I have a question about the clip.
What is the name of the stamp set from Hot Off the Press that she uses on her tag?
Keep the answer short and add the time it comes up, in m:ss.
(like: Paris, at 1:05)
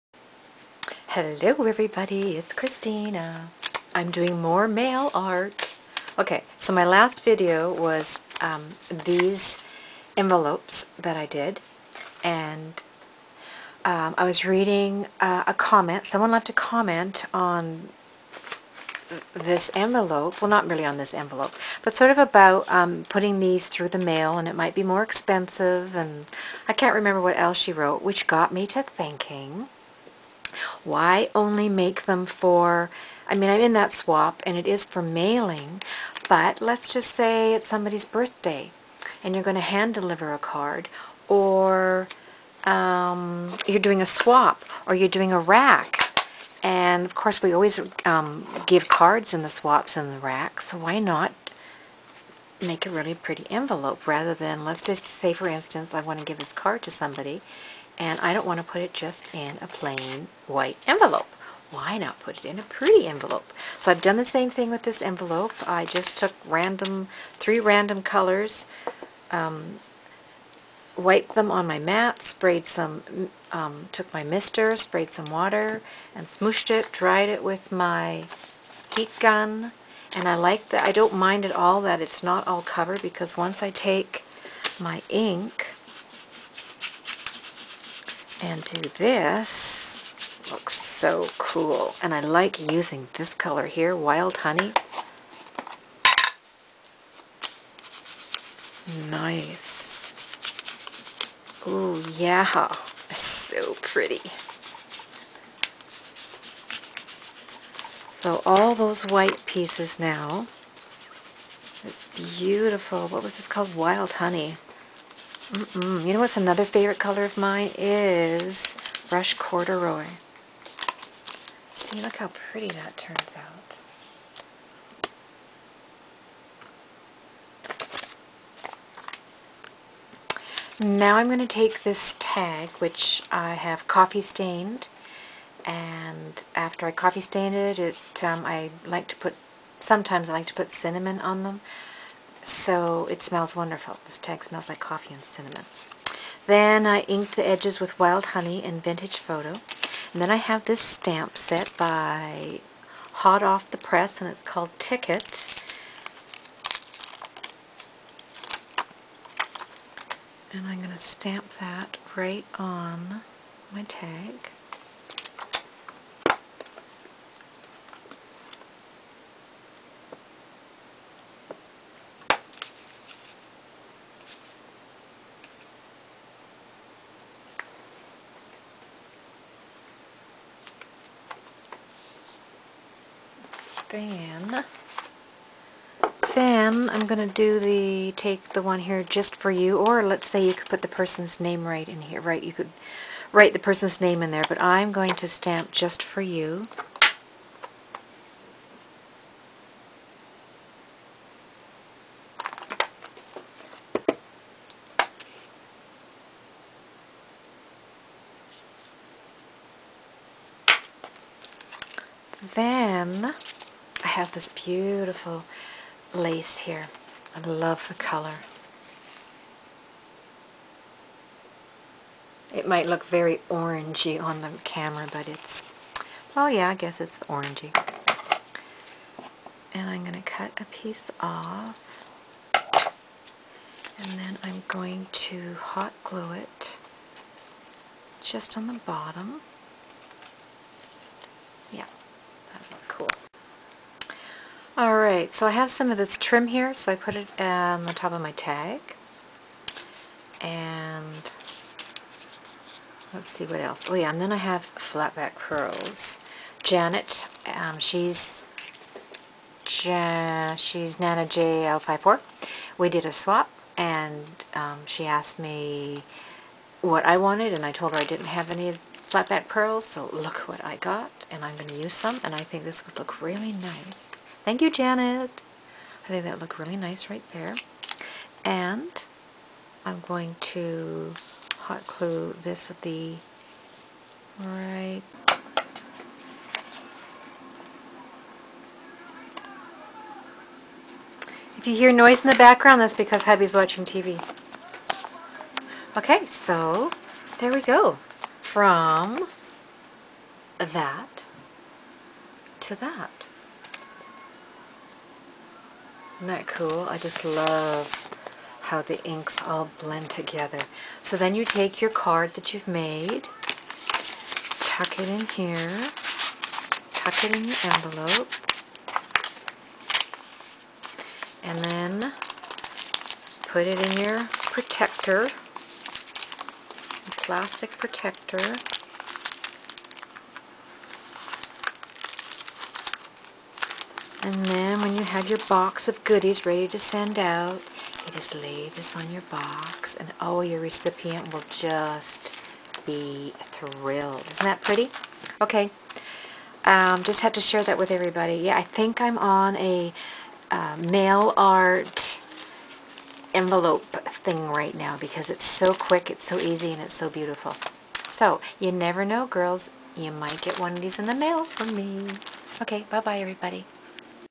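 Ticket, at 2:34.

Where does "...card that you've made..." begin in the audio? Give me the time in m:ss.
5:11.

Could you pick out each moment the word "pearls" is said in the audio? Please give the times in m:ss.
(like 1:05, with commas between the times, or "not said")
4:15, 4:29.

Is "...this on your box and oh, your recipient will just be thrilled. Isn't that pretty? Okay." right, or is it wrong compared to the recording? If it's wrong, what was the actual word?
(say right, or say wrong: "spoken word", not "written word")
right.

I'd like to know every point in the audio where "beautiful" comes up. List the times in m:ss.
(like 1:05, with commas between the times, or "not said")
1:52, 3:34, 5:57.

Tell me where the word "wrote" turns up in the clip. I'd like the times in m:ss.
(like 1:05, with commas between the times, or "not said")
0:27.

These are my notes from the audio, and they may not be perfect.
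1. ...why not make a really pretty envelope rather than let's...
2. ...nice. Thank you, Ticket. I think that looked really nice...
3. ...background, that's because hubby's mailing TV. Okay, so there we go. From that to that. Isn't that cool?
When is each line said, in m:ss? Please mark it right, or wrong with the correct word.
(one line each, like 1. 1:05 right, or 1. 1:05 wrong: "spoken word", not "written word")
1. 0:50 right
2. 4:33 wrong: "Janet", not "Ticket"
3. 4:52 wrong: "watching", not "mailing".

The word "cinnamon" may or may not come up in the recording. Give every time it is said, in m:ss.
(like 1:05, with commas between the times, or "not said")
2:20, 2:25.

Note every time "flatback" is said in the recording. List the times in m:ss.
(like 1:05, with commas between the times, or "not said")
4:14, 4:29.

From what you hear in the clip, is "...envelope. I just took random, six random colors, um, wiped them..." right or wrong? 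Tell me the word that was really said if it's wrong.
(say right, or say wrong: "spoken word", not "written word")
wrong: "three", not "six".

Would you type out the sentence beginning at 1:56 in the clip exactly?
You know what's another favorite color of mine is brush corduroy.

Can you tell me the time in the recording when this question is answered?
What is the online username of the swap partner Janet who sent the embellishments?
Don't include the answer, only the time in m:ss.
4:20.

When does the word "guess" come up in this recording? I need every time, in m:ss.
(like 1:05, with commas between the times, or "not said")
3:46.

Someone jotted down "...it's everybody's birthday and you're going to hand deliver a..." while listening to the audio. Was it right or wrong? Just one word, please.
wrong.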